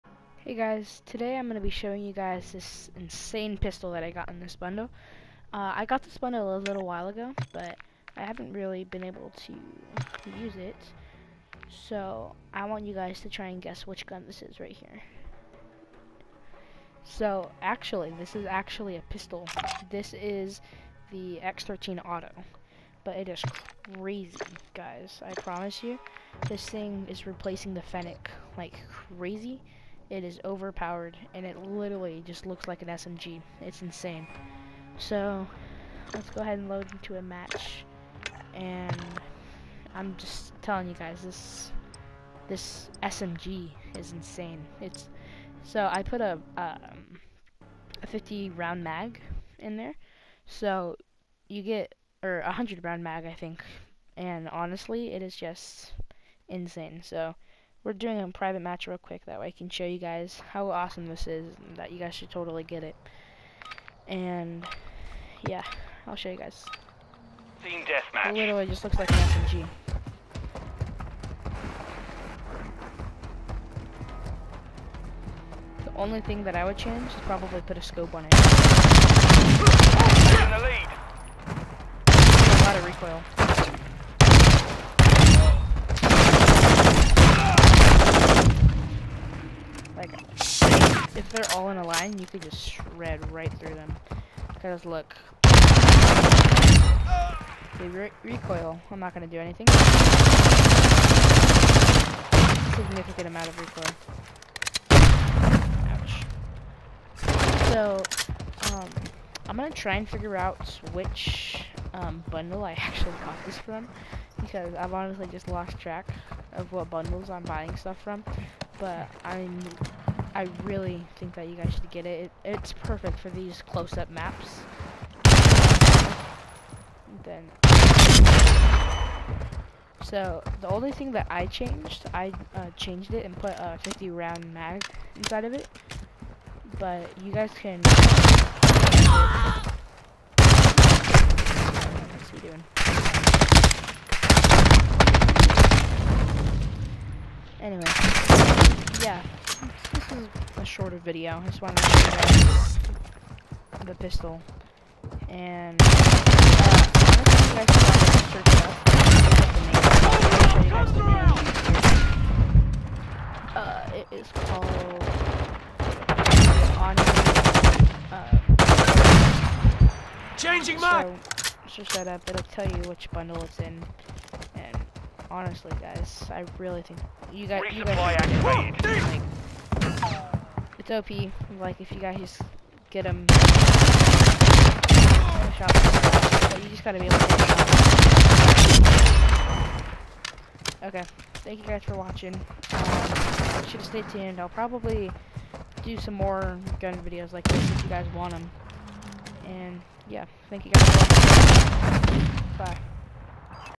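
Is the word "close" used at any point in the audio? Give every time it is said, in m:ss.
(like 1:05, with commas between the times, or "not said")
2:03.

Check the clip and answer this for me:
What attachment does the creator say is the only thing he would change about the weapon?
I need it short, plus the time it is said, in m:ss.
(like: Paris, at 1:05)
a scope, at 1:17.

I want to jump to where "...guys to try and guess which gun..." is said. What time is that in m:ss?
0:12.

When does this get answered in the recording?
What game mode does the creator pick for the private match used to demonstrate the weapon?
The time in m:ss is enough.
1:07.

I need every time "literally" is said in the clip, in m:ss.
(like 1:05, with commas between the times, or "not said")
0:31, 1:08.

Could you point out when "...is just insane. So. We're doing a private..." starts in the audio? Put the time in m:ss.
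0:55.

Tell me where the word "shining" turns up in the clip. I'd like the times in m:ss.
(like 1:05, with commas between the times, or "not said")
not said.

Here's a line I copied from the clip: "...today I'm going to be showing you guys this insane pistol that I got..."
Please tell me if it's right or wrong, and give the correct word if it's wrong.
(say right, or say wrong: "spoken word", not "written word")
right.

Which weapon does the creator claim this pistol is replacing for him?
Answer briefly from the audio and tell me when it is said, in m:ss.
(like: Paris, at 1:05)
Fennec, at 0:27.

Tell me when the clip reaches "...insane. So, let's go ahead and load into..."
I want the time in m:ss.
0:33.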